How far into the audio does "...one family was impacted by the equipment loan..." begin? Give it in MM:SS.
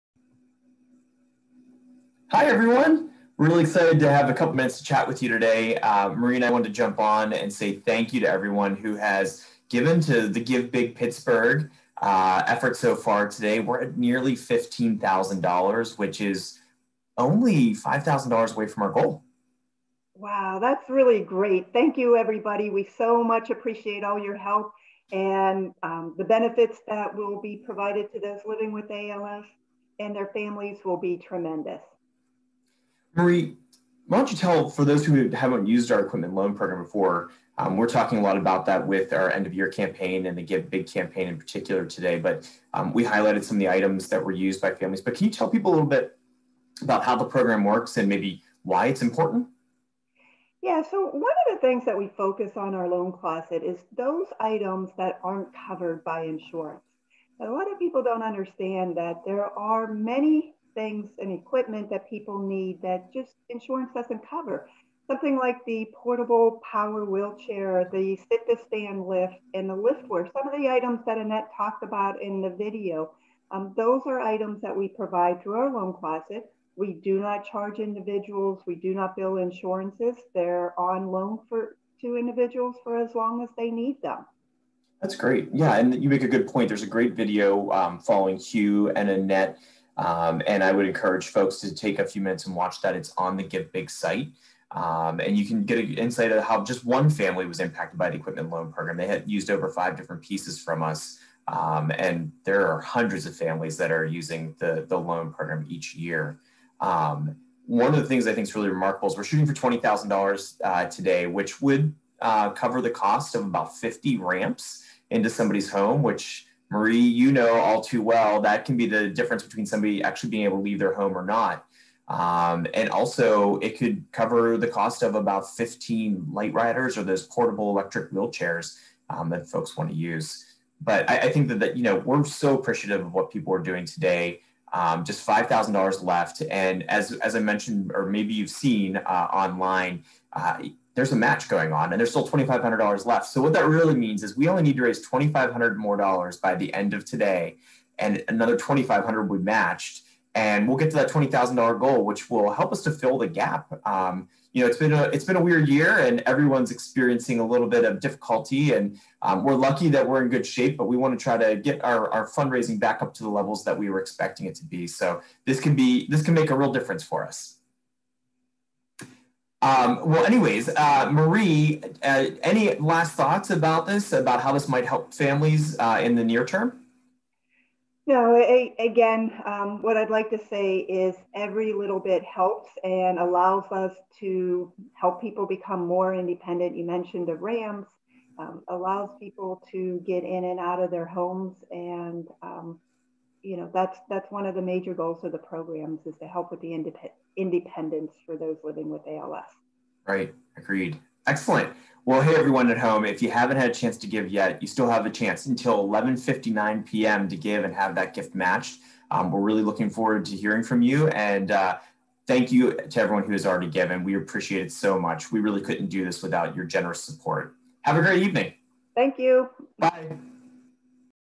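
01:36.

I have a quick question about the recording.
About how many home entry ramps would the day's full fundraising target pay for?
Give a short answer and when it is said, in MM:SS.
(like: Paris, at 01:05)
50, at 01:53.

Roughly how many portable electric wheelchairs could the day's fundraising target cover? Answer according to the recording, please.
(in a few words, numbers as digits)
15.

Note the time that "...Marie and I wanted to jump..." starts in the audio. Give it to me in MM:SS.
00:06.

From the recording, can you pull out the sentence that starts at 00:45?
But can you tell people a little bit about how the program works and maybe why it's important?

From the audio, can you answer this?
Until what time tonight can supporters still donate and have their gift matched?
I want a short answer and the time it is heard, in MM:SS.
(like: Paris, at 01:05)
11:59 p.m., at 03:25.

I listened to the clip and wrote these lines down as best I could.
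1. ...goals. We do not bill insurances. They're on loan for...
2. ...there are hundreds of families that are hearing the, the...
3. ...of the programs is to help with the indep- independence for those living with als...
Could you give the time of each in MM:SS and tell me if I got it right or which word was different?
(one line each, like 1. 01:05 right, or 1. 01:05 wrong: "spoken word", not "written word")
1. 01:17 wrong: "individuals", not "goals"
2. 01:42 wrong: "using", not "hearing"
3. 03:15 right.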